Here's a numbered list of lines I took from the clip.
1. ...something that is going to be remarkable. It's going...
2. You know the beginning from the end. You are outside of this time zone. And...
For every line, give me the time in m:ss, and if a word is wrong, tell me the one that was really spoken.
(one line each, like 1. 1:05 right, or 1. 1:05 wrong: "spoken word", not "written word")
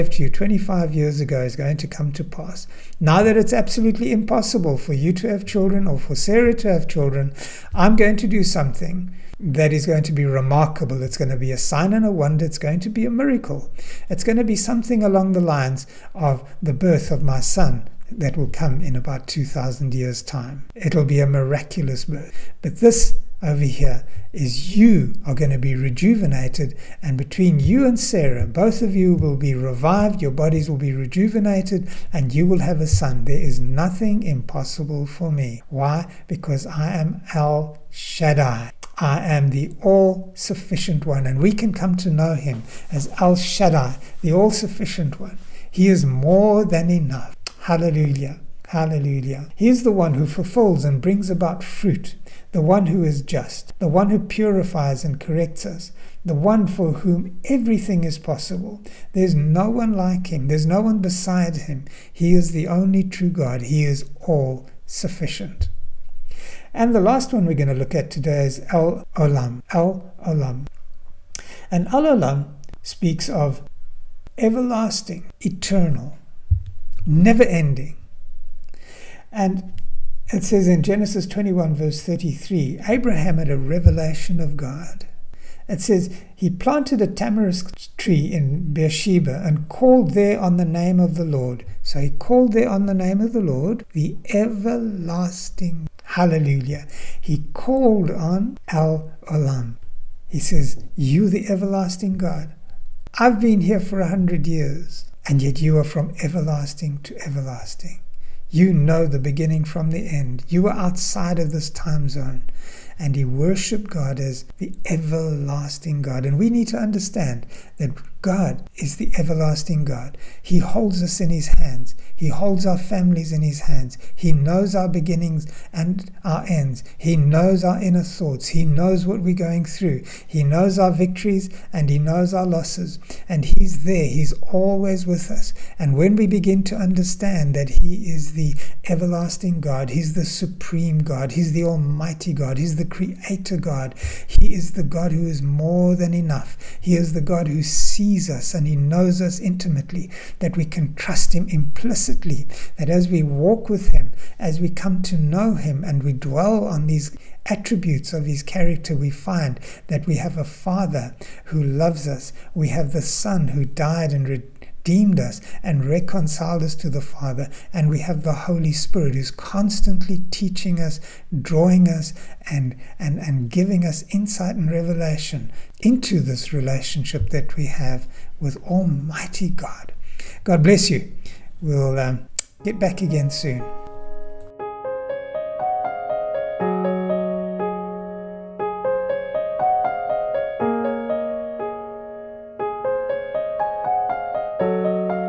1. 0:08 right
2. 1:48 right.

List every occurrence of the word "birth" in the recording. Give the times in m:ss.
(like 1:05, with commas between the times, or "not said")
0:16, 0:22.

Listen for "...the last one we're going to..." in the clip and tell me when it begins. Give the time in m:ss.
1:06.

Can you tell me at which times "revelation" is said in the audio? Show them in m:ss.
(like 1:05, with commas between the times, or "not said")
1:23, 2:54.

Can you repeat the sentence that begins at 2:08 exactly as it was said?
He knows what we're going through.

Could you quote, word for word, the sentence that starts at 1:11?
And Al Olam speaks of everlasting, eternal, never ending.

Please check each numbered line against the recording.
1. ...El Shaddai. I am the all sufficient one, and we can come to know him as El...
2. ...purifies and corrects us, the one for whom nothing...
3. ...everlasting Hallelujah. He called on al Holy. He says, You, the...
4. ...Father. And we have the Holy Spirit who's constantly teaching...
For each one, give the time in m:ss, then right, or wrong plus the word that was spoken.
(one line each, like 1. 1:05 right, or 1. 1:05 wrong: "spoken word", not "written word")
1. 0:37 right
2. 0:54 wrong: "everything", not "nothing"
3. 1:34 wrong: "Olam", not "Holy"
4. 2:47 right.